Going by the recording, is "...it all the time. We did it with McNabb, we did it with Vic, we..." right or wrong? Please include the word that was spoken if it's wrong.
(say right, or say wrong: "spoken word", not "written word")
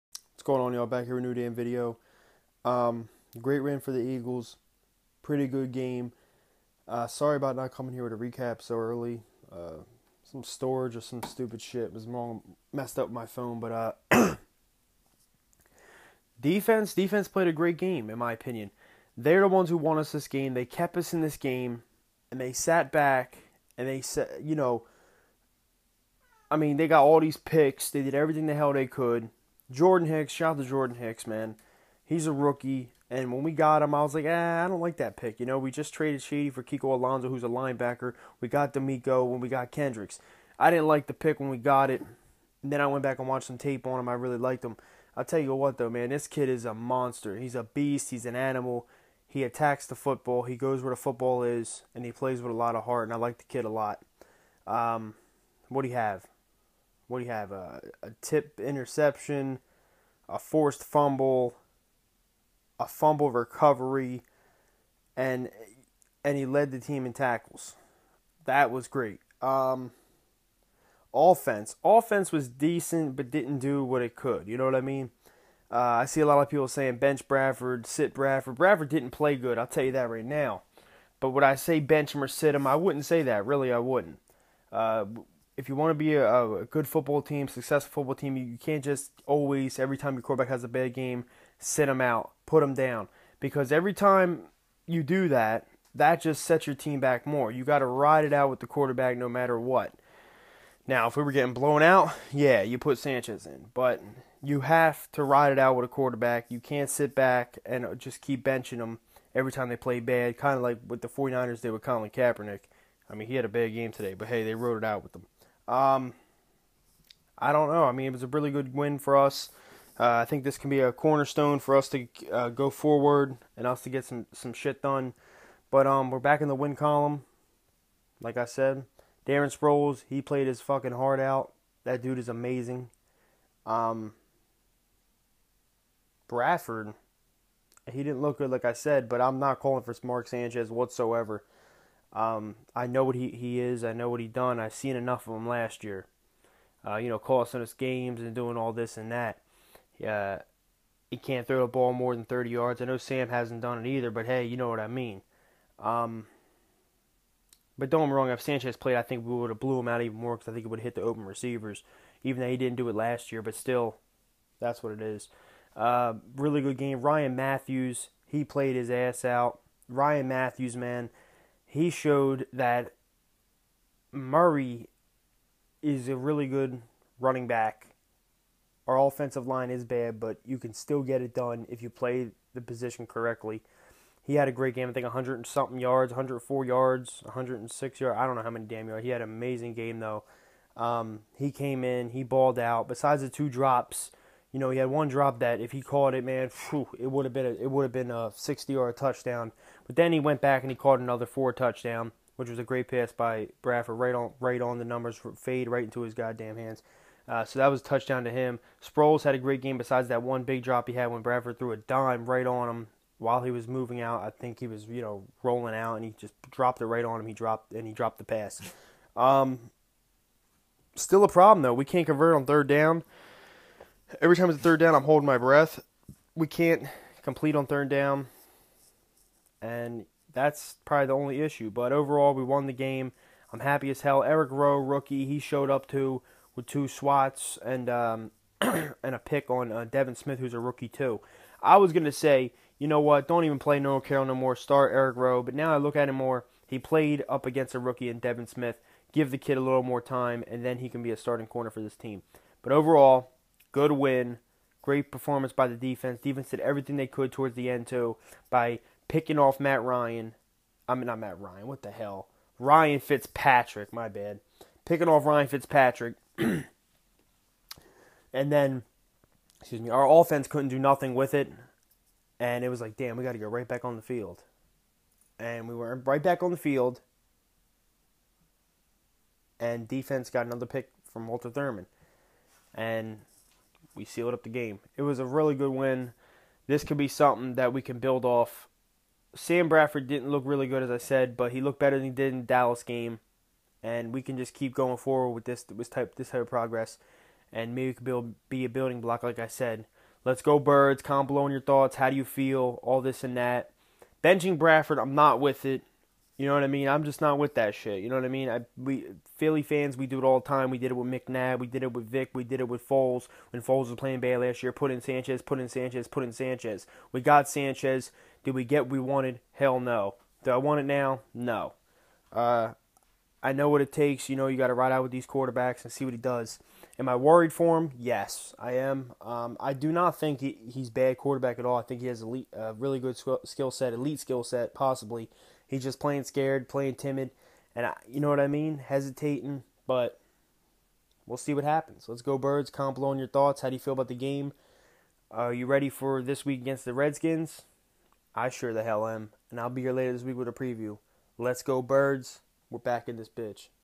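right.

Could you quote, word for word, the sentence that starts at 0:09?
Uh, some storage or some stupid shit was wrong, messed up my phone.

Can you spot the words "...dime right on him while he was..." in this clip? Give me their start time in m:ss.
3:31.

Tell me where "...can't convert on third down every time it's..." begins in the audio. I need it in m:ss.
3:41.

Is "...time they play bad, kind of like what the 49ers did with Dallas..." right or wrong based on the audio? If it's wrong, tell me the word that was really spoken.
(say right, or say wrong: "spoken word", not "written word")
wrong: "Colin", not "Dallas".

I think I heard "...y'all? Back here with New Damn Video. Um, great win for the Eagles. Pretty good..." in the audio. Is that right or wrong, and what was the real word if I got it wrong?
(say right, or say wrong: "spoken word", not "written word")
right.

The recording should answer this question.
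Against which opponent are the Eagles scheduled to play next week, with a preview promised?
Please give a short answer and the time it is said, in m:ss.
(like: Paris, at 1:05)
Redskins, at 5:46.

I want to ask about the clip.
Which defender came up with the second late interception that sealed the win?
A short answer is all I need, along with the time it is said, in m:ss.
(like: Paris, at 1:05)
Walter Thurman, at 4:41.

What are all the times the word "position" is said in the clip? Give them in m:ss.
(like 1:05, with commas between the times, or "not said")
3:02.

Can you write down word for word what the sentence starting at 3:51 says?
But overall, we won the game.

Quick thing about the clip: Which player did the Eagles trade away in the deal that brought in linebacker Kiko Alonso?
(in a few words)
Shady.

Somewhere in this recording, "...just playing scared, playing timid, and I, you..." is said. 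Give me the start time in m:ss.
5:35.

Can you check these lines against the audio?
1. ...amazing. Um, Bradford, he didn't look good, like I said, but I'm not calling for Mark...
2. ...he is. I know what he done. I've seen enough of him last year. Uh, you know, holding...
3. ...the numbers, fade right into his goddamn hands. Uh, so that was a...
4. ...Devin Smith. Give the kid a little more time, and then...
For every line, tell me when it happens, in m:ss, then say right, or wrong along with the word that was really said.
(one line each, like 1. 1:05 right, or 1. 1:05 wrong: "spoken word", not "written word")
1. 2:12 right
2. 2:23 wrong: "costing", not "holding"
3. 3:24 right
4. 4:08 right.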